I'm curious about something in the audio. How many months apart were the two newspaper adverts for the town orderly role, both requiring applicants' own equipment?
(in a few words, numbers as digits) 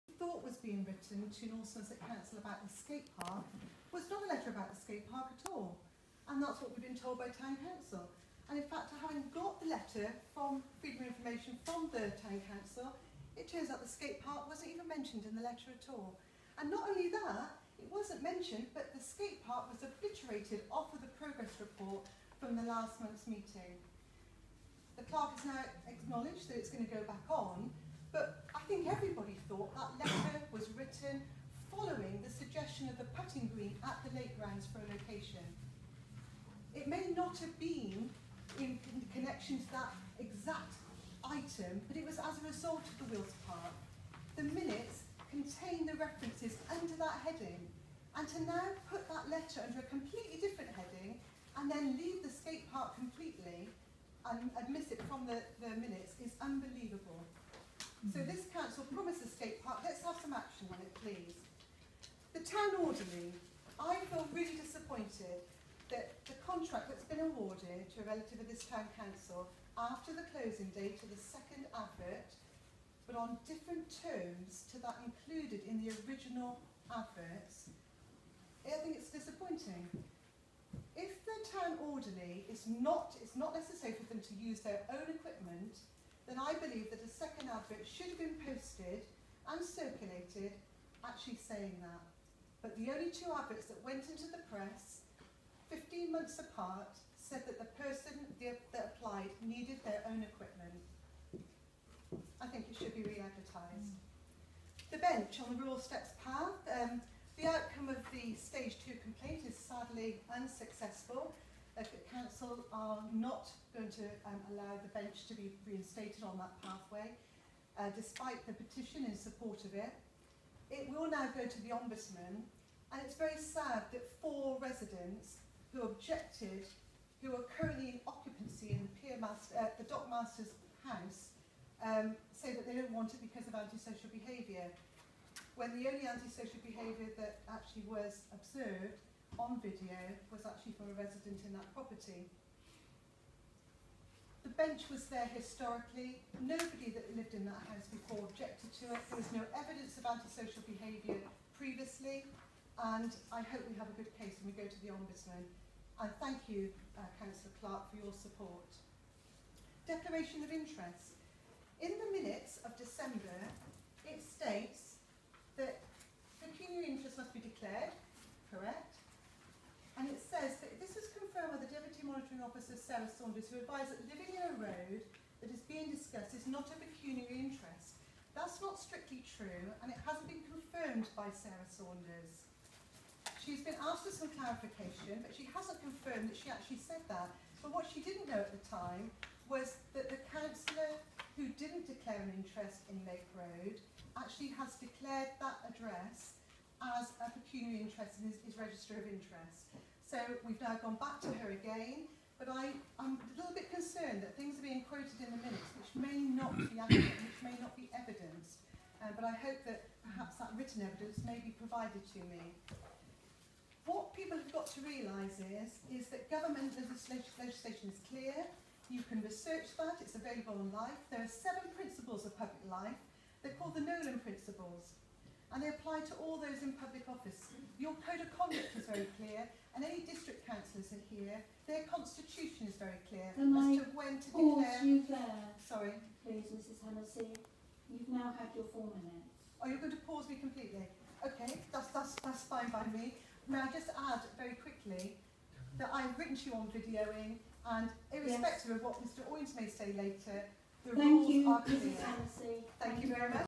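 15.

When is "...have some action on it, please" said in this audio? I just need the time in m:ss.
1:00.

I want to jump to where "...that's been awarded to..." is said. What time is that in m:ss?
1:06.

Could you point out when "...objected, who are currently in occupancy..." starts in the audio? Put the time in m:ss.
2:05.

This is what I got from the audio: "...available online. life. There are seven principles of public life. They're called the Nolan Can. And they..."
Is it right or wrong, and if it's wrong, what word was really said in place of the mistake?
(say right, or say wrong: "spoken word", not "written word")
wrong: "Principles", not "Can".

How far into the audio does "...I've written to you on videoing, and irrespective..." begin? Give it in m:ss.
4:05.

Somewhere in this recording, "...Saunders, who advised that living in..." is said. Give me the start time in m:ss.
2:53.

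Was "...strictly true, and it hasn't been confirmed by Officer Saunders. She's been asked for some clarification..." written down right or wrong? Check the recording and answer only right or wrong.
wrong.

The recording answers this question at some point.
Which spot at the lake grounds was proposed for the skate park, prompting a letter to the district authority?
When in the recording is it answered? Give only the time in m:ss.
0:32.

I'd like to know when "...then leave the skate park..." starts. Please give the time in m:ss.
0:51.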